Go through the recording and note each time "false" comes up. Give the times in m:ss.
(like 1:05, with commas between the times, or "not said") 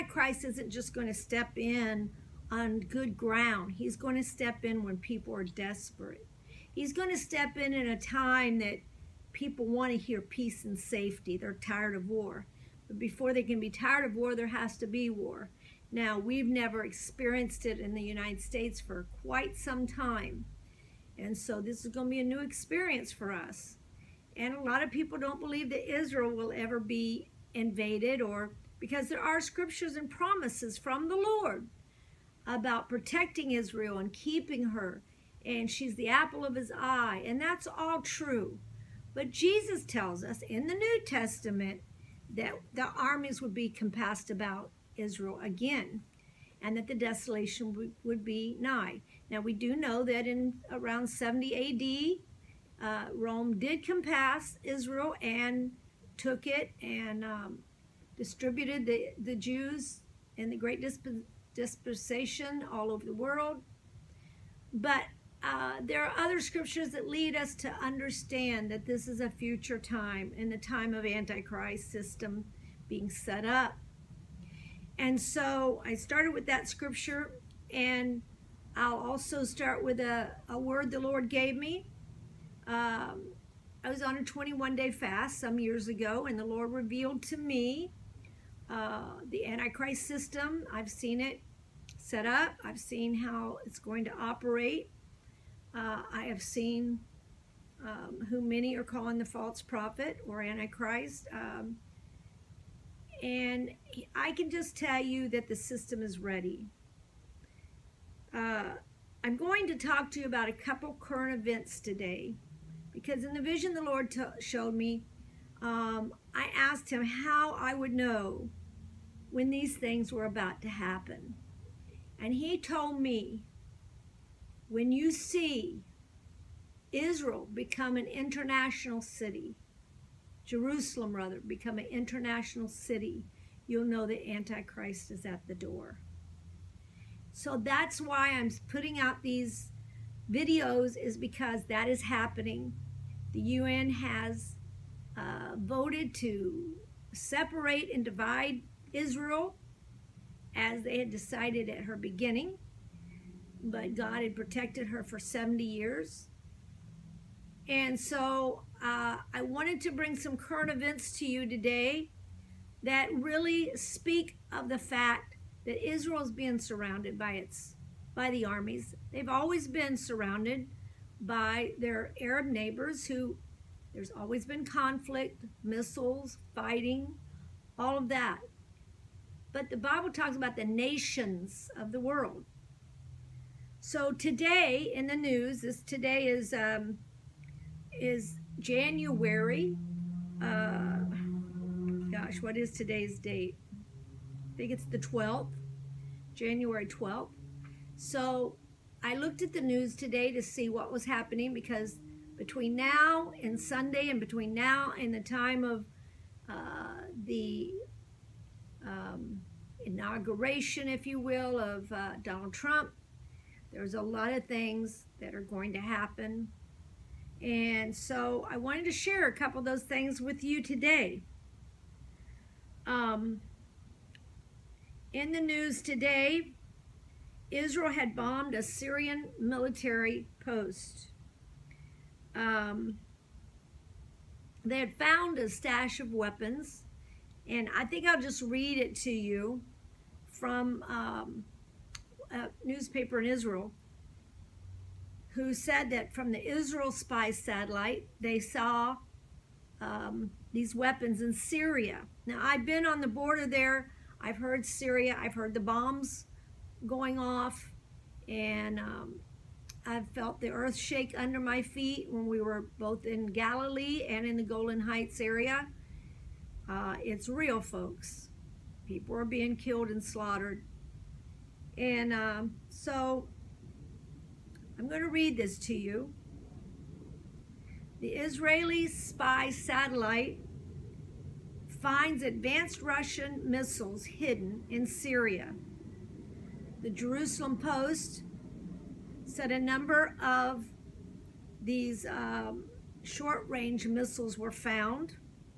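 1:39.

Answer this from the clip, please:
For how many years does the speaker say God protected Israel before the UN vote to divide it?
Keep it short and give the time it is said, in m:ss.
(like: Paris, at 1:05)
70, at 2:35.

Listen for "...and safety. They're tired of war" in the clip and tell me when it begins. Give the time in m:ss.
0:10.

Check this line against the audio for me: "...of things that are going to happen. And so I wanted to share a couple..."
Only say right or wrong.
right.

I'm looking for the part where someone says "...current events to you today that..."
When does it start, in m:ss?
2:40.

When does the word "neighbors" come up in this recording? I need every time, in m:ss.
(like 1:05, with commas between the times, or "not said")
2:52.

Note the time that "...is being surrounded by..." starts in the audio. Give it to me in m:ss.
2:46.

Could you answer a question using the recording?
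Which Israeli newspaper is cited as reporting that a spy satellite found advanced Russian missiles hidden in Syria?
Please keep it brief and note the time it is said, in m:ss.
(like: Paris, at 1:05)
The Jerusalem Post, at 4:46.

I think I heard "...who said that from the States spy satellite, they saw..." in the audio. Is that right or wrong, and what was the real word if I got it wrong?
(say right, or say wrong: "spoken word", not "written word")
wrong: "Israel", not "States".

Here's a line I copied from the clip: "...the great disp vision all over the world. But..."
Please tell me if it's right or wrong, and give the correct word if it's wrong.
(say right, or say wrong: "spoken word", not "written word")
wrong: "dispensation", not "vision".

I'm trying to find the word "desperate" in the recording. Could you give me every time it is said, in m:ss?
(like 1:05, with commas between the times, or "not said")
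0:05.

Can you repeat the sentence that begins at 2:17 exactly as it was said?
So that's why I'm putting out these videos is because that is happening.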